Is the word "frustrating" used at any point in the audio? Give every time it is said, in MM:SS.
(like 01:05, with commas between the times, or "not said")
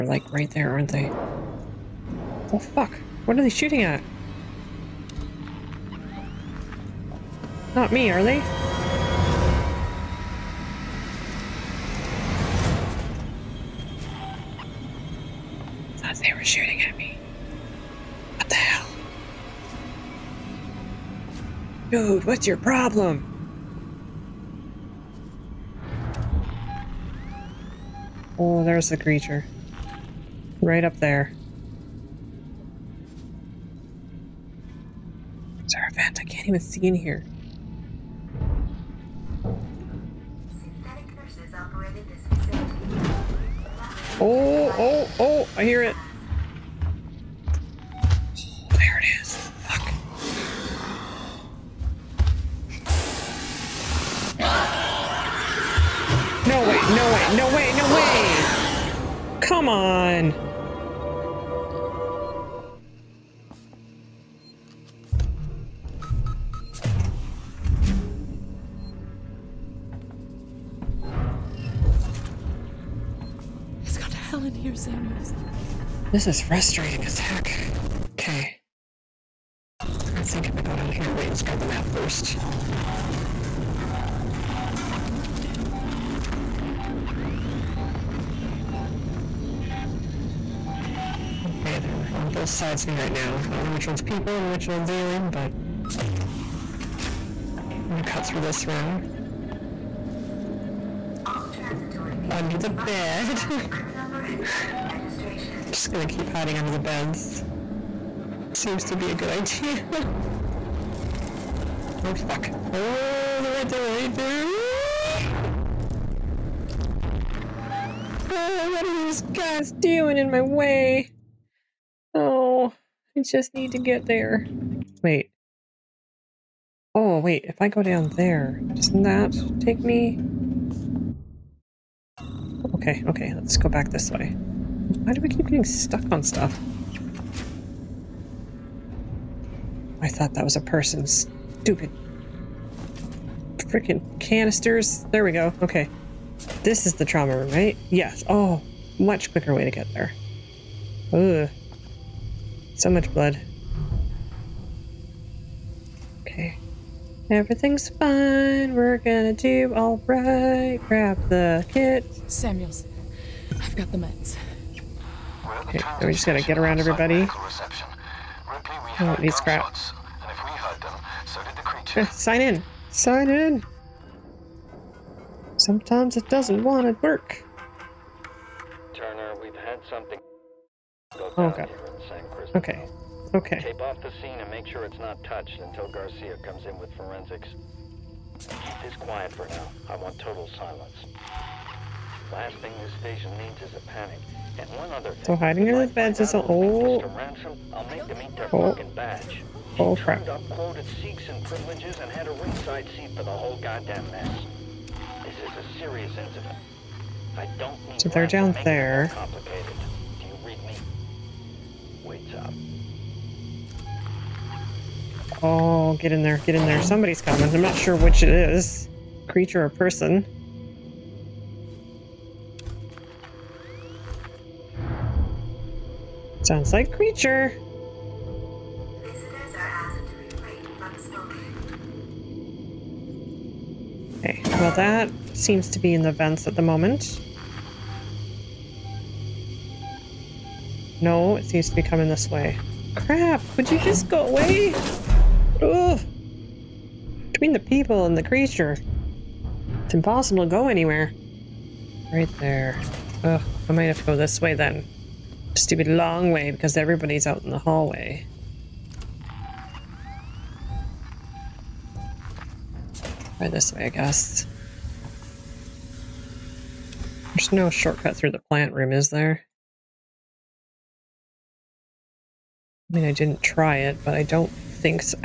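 01:16.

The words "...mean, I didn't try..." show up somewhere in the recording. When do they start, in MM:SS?
04:32.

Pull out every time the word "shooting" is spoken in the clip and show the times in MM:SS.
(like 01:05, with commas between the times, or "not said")
00:03, 00:16.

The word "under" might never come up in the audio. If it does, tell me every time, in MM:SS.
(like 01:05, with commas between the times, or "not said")
01:42, 01:46.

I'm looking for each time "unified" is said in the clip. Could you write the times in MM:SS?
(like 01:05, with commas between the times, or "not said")
not said.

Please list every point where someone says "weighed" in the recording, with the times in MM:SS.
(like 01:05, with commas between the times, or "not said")
not said.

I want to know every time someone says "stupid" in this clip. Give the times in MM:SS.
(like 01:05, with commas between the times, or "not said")
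02:21, 04:15.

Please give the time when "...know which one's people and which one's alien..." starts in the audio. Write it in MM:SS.
01:33.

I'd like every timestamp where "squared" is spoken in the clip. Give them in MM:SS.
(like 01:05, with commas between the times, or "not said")
not said.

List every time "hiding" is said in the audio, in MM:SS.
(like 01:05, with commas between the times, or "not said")
01:46, 03:15.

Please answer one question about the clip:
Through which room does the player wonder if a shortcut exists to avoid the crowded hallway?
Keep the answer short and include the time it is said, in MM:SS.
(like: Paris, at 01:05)
Plant room, at 04:28.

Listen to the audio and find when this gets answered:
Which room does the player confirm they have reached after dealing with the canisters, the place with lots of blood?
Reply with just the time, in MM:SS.
02:27.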